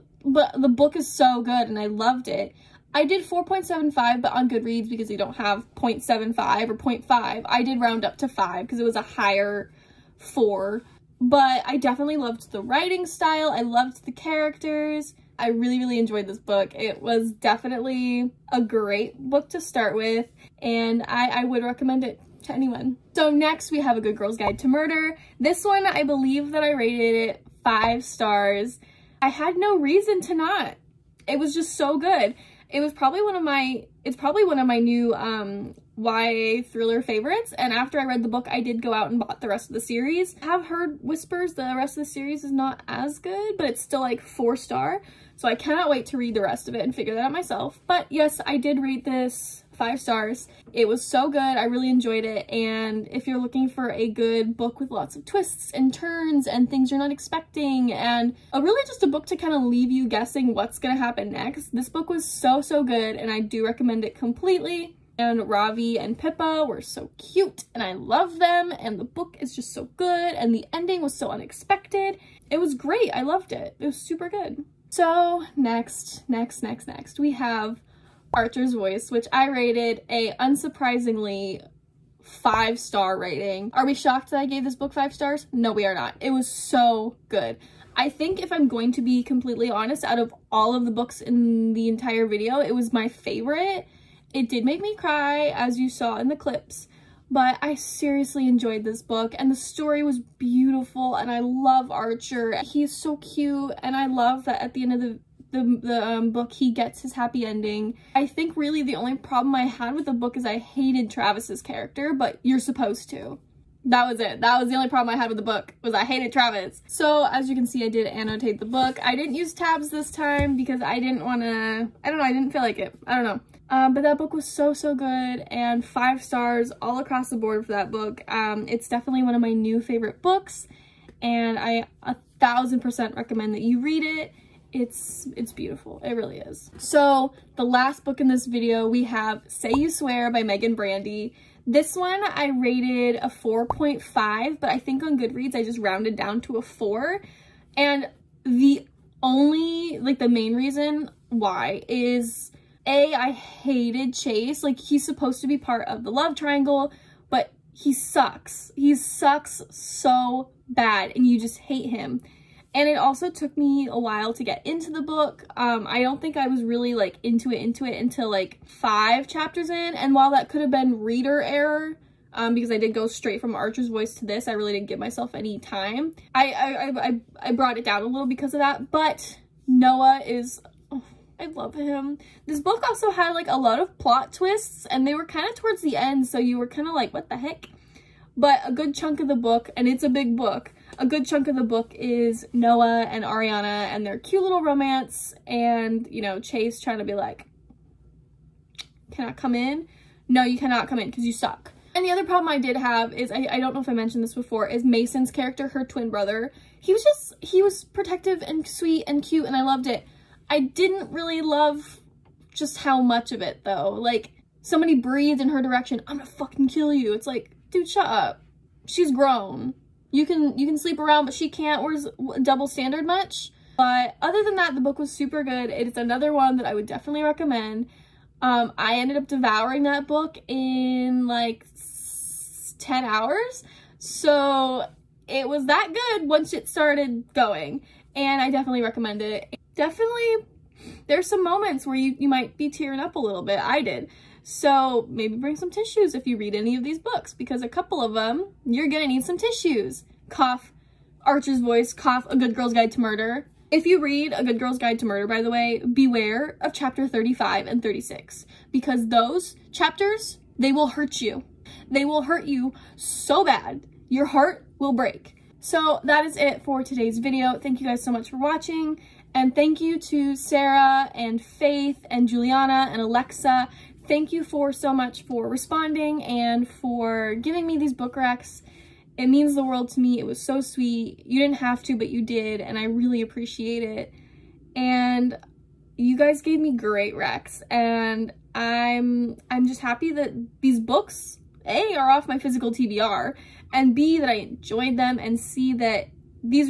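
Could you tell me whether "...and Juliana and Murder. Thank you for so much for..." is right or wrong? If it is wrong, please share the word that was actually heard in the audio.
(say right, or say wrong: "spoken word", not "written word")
wrong: "Alexa", not "Murder".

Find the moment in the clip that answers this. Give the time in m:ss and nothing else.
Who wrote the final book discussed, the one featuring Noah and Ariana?
2:20.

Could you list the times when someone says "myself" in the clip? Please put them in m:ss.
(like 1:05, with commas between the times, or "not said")
0:47, 2:54.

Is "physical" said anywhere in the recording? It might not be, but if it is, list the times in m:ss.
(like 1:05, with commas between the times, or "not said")
4:52.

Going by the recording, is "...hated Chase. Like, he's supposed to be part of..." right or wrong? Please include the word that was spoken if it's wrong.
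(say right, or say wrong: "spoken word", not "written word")
right.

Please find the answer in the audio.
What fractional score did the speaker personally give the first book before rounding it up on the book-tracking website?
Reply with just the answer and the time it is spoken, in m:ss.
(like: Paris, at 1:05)
4.75, at 0:03.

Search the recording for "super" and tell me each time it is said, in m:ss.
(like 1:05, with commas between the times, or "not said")
1:14, 3:45.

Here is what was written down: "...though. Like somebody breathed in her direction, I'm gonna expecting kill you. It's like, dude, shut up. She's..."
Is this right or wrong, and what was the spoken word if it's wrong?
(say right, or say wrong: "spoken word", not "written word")
wrong: "fucking", not "expecting".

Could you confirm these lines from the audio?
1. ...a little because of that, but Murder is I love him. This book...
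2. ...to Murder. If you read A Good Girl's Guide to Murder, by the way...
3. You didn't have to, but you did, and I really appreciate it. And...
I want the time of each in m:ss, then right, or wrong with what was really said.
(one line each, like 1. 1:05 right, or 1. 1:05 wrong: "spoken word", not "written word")
1. 2:58 wrong: "Noah", not "Murder"
2. 4:12 right
3. 4:41 right.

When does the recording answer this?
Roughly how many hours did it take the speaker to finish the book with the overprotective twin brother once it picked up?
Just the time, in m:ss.
3:52.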